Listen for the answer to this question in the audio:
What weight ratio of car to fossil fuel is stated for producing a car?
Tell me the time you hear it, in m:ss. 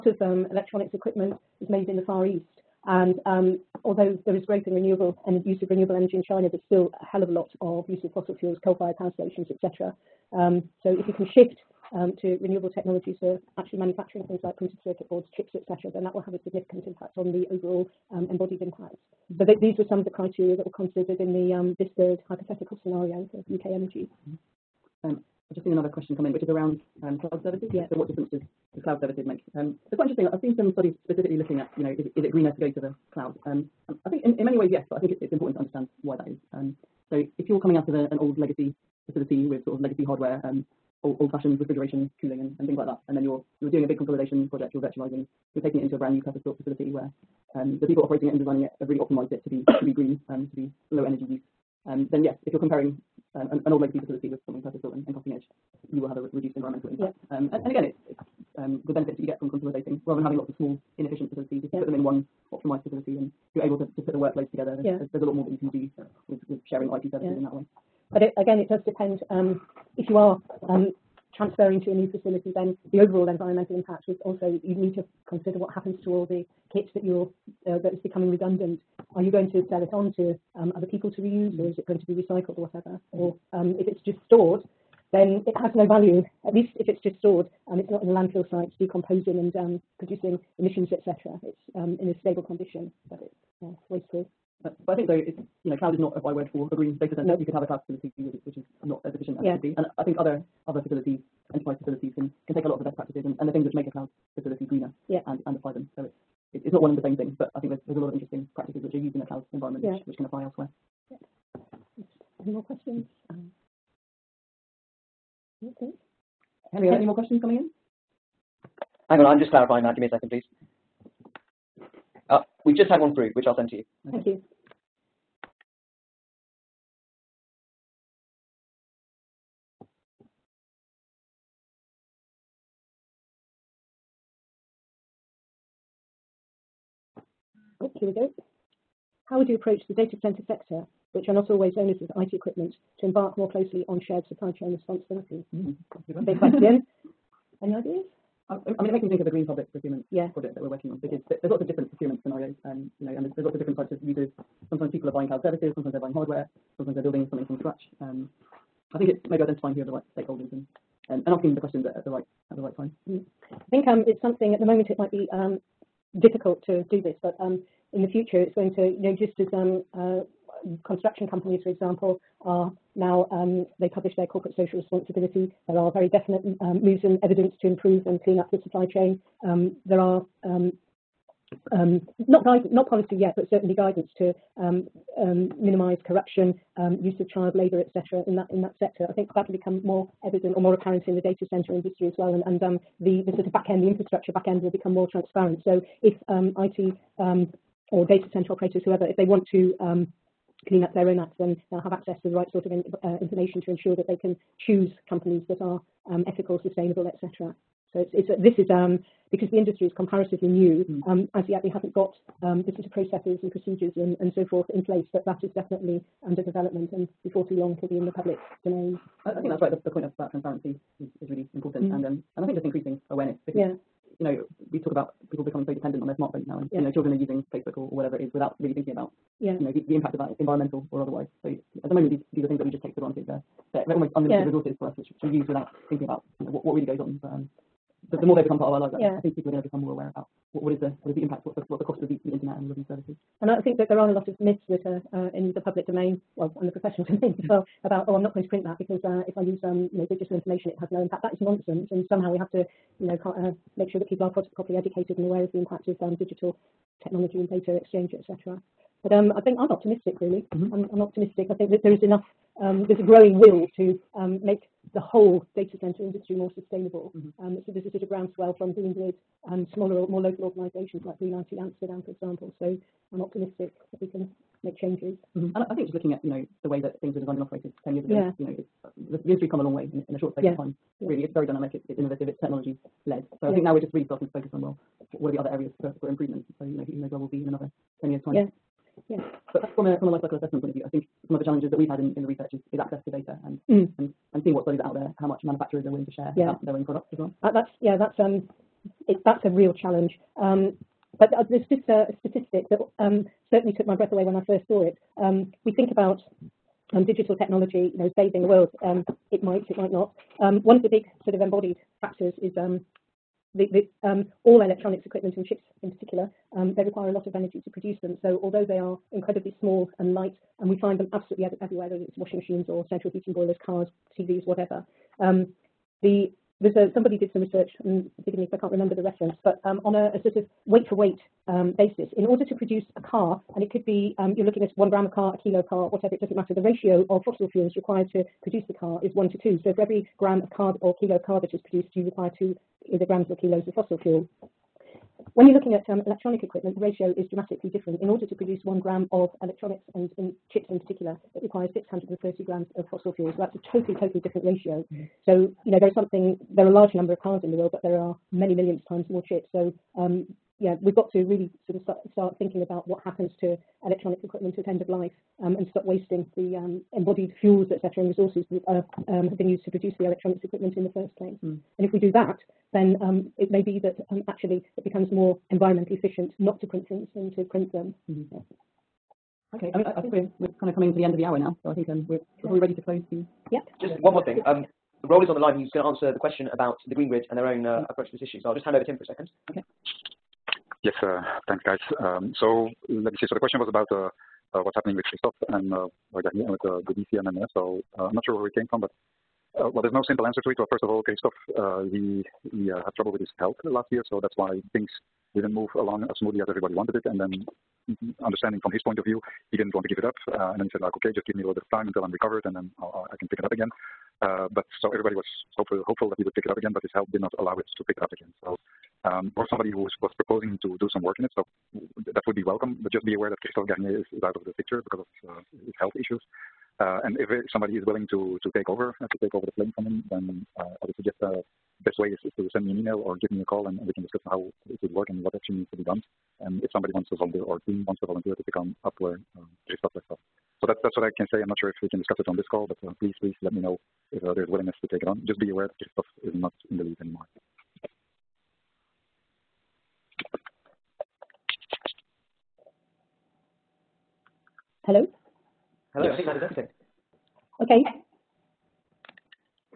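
5:39.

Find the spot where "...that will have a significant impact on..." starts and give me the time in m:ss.
0:16.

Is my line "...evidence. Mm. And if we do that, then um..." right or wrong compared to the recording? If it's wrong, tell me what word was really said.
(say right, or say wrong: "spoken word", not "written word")
wrong: "place", not "evidence".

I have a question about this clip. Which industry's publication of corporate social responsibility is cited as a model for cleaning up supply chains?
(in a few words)
construction.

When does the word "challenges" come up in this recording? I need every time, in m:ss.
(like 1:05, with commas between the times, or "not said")
4:51, 4:59.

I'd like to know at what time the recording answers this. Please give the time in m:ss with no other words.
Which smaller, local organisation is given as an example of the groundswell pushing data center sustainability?
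4:31.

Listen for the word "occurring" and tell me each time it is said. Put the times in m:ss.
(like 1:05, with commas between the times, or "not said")
not said.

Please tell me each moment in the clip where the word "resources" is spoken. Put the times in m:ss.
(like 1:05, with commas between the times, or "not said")
3:54, 6:08.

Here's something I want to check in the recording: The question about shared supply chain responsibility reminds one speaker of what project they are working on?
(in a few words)
green public procurement.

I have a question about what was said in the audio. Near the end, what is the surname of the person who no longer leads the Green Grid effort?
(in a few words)
Garnier.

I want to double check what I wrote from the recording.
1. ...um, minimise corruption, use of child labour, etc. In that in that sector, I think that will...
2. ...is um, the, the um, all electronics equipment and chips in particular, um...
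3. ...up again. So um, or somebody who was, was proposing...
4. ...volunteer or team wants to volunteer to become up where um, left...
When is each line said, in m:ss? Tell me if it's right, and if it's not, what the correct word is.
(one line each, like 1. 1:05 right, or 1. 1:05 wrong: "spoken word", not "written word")
1. 3:04 right
2. 5:12 right
3. 6:58 right
4. 7:17 right.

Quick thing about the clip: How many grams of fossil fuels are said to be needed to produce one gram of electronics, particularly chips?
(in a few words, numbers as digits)
630.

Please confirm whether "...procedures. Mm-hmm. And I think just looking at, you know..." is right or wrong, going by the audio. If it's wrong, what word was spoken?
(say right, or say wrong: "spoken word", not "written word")
wrong: "changes", not "procedures".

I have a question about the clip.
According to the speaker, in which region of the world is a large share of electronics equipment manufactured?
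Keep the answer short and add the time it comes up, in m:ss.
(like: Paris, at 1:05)
Far East, at 0:02.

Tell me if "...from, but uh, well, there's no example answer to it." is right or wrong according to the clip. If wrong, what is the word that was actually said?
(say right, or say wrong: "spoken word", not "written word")
wrong: "simple", not "example".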